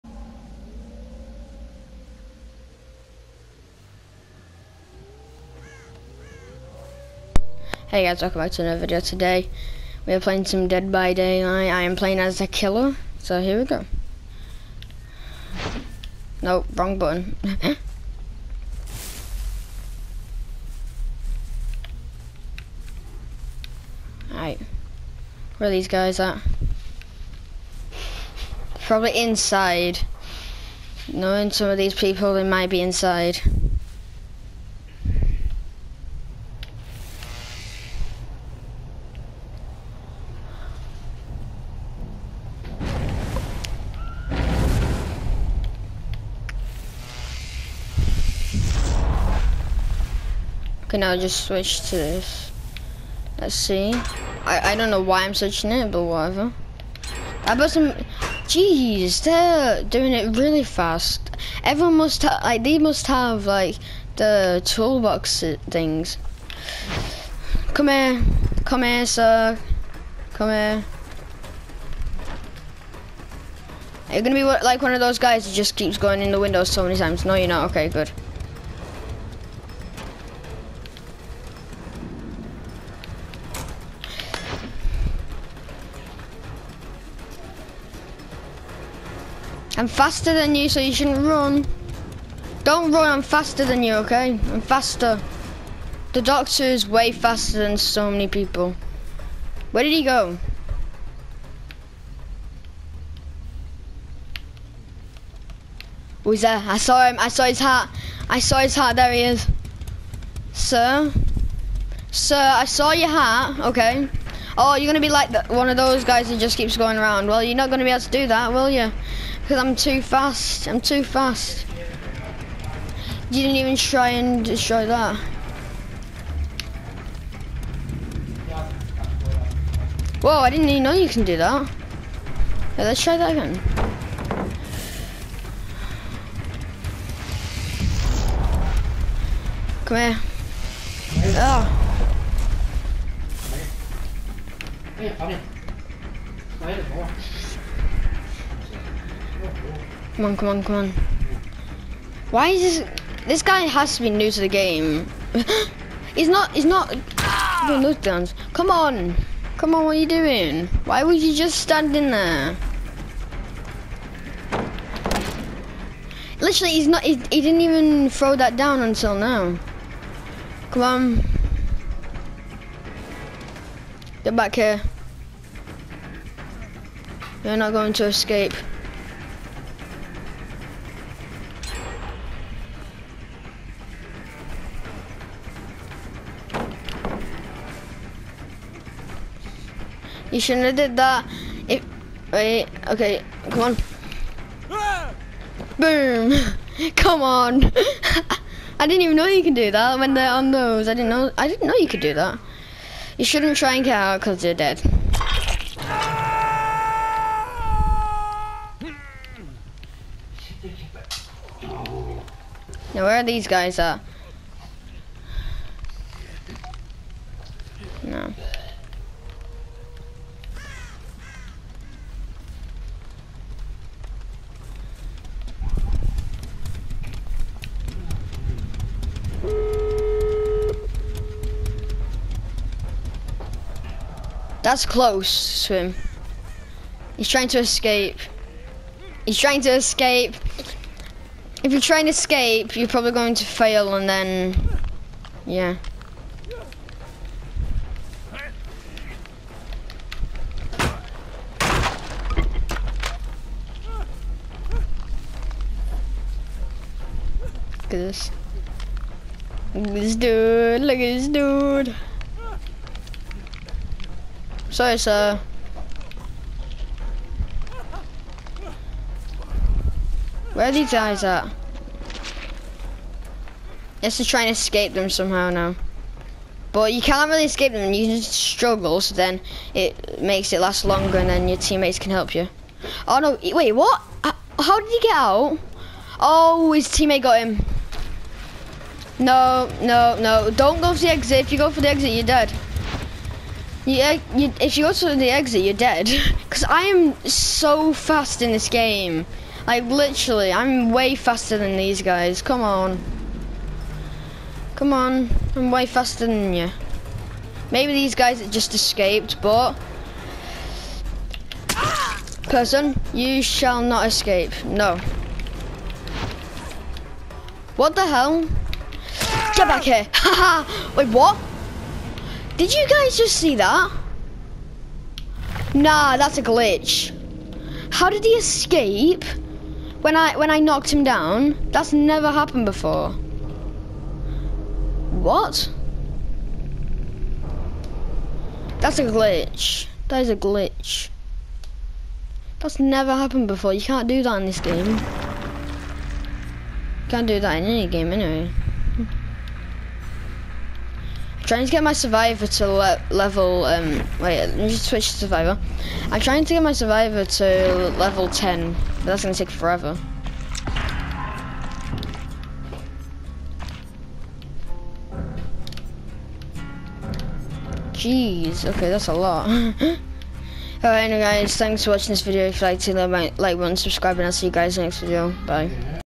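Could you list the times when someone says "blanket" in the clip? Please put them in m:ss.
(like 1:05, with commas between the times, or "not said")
not said.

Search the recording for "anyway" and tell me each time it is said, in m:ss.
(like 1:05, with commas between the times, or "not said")
5:48, 6:10.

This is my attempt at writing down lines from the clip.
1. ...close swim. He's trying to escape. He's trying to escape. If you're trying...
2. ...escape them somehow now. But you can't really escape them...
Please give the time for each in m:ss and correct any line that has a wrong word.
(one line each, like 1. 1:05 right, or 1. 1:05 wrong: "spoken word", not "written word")
1. 3:54 right
2. 4:34 right.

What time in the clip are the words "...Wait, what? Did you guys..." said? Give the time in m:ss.
5:20.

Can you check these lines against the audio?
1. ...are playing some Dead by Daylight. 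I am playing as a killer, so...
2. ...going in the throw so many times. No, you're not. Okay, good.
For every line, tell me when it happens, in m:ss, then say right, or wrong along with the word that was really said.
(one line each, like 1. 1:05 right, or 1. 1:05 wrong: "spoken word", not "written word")
1. 0:10 right
2. 1:15 wrong: "window", not "throw".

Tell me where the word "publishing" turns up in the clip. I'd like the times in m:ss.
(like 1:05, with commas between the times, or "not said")
not said.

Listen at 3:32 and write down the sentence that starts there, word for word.
Now where are these guys at?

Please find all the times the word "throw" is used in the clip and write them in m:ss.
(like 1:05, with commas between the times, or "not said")
2:48.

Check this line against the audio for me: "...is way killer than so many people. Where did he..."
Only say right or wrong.
wrong.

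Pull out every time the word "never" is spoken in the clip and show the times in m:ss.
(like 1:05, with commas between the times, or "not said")
5:31, 5:42.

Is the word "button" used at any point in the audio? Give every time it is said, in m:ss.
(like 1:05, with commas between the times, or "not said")
0:16, 6:13.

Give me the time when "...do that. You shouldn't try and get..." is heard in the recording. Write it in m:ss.
3:21.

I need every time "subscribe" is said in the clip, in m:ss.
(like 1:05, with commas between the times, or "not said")
6:13.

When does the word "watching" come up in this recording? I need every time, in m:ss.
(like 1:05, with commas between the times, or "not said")
6:11.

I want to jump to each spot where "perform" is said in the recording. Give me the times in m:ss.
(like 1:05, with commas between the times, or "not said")
not said.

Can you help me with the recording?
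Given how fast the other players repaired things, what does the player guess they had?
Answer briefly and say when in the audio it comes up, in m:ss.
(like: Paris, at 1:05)
Toolbox things, at 1:04.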